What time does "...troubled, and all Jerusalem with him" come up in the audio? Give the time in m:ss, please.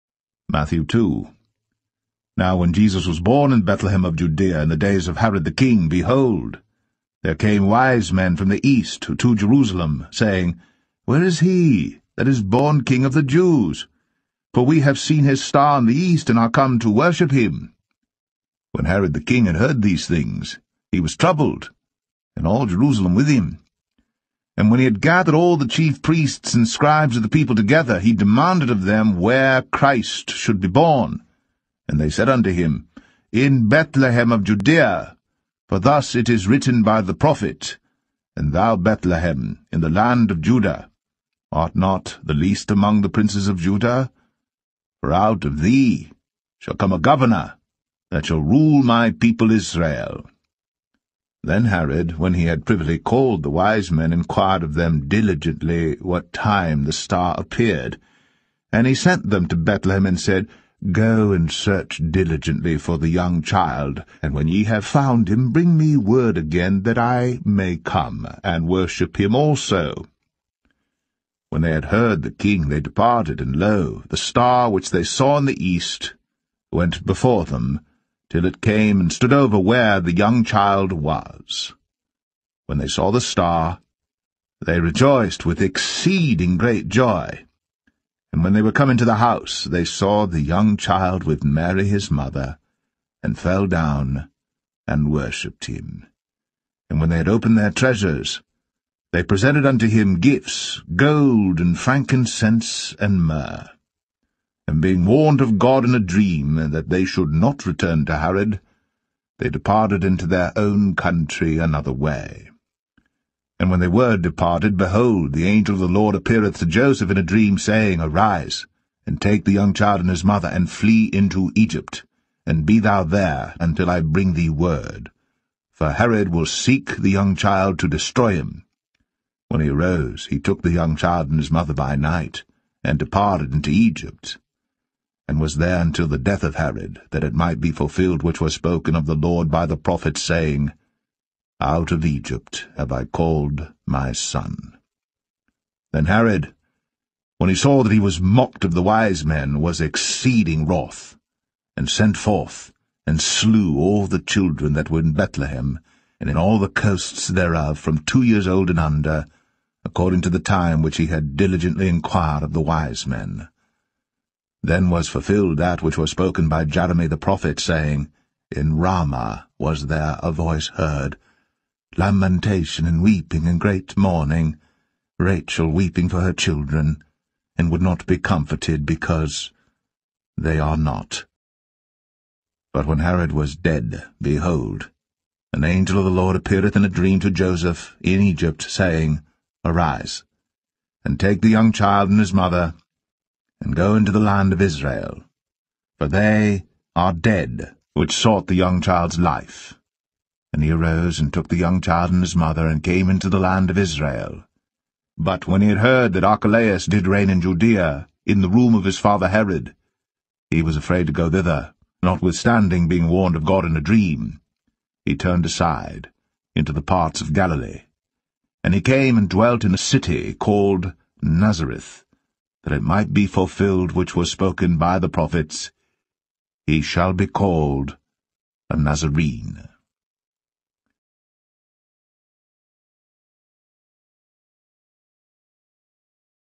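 0:21.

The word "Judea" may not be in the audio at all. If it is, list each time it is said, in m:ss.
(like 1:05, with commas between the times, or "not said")
0:04, 0:34, 3:27.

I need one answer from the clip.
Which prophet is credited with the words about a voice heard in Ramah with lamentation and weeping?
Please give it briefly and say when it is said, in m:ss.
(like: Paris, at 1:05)
Jeremy, at 2:46.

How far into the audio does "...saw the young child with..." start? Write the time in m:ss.
1:29.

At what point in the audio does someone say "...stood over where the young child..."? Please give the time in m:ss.
1:19.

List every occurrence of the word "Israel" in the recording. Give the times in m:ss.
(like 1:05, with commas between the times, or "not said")
0:49, 3:14, 3:23.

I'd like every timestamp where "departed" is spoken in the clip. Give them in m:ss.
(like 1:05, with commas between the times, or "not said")
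1:12, 1:49, 1:54, 2:12.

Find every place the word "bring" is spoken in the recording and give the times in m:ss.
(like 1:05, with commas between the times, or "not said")
1:05, 2:04.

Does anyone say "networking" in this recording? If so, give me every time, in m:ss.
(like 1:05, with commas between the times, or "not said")
not said.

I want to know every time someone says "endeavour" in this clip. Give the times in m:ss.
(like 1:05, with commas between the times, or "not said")
not said.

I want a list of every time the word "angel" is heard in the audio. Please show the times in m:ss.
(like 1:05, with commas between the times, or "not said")
1:55, 3:05.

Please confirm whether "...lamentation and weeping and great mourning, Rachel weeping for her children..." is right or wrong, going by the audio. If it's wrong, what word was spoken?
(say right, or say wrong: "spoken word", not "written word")
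right.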